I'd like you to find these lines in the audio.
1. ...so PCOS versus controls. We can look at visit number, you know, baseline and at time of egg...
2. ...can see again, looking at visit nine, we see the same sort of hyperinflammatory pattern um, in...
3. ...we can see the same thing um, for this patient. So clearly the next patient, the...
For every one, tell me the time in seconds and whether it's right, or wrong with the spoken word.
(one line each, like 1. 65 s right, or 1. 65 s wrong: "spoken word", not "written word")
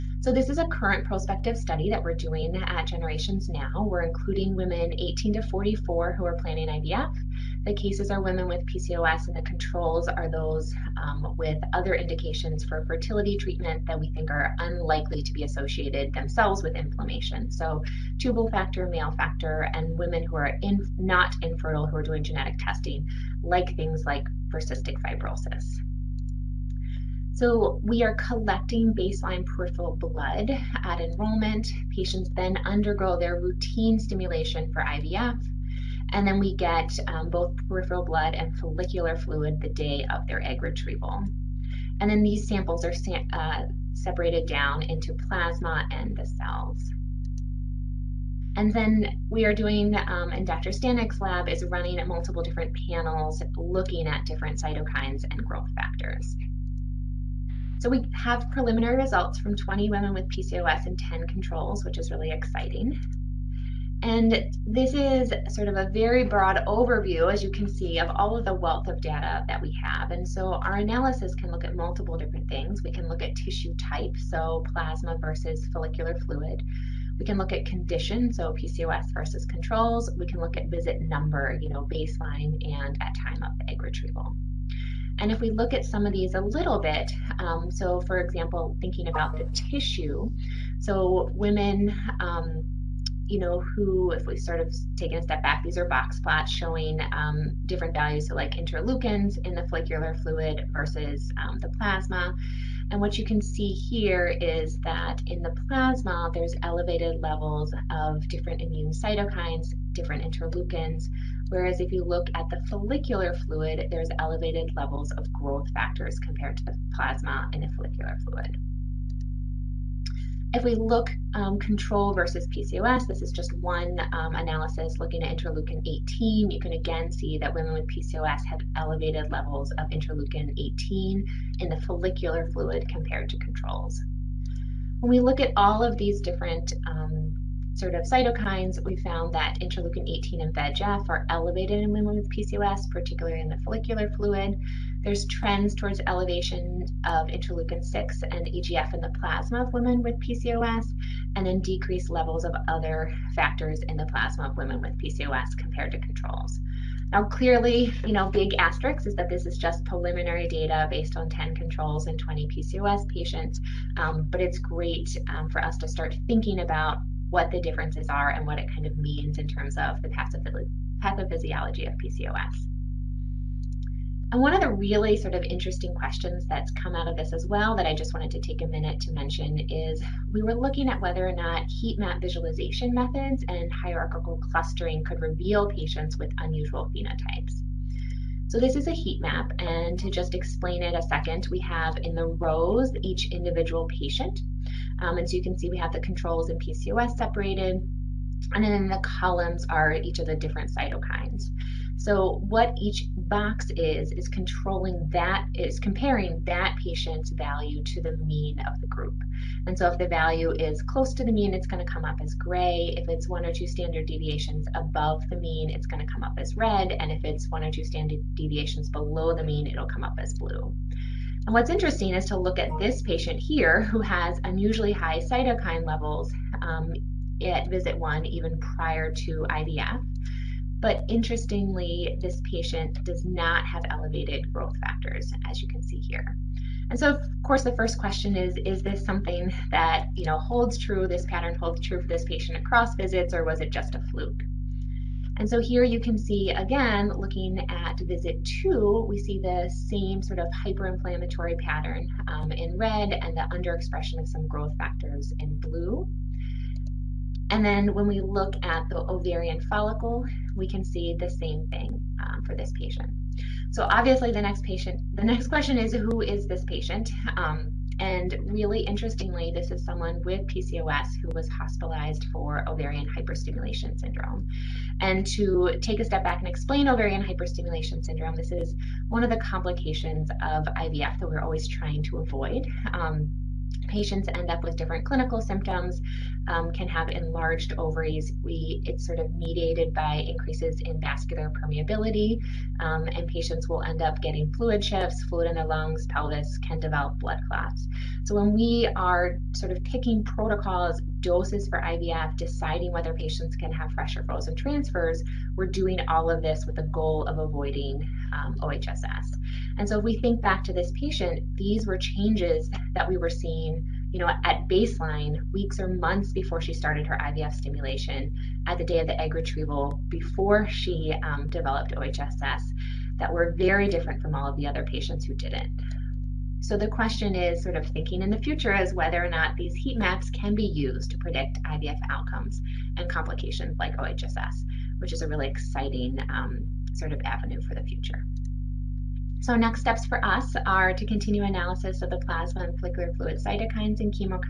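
1. 78 s right
2. 246 s wrong: "two", not "nine"
3. 260 s wrong: "obviously", not "clearly".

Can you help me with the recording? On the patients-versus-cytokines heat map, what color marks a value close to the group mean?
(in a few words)
gray.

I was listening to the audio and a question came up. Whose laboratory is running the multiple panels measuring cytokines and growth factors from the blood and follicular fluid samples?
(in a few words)
Dr. Stanic's lab.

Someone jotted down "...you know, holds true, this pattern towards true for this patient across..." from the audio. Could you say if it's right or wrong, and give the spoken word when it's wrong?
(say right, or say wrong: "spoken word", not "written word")
wrong: "holds", not "towards".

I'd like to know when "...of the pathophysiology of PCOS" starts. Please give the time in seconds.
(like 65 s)
169 s.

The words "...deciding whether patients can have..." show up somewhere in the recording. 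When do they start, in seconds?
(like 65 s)
302 s.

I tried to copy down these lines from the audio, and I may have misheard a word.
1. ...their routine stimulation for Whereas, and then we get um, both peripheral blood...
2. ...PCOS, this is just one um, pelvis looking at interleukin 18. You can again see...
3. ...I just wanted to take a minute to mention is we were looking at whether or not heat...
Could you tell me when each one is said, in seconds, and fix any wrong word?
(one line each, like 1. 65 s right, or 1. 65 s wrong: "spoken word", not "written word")
1. 33 s wrong: "IVF", not "Whereas"
2. 122 s wrong: "analysis", not "pelvis"
3. 177 s right.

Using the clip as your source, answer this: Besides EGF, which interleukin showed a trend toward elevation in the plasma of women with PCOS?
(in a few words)
interleukin 6.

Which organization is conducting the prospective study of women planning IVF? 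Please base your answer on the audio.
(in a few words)
Generations Now.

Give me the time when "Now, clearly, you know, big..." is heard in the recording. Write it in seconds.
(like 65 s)
157 s.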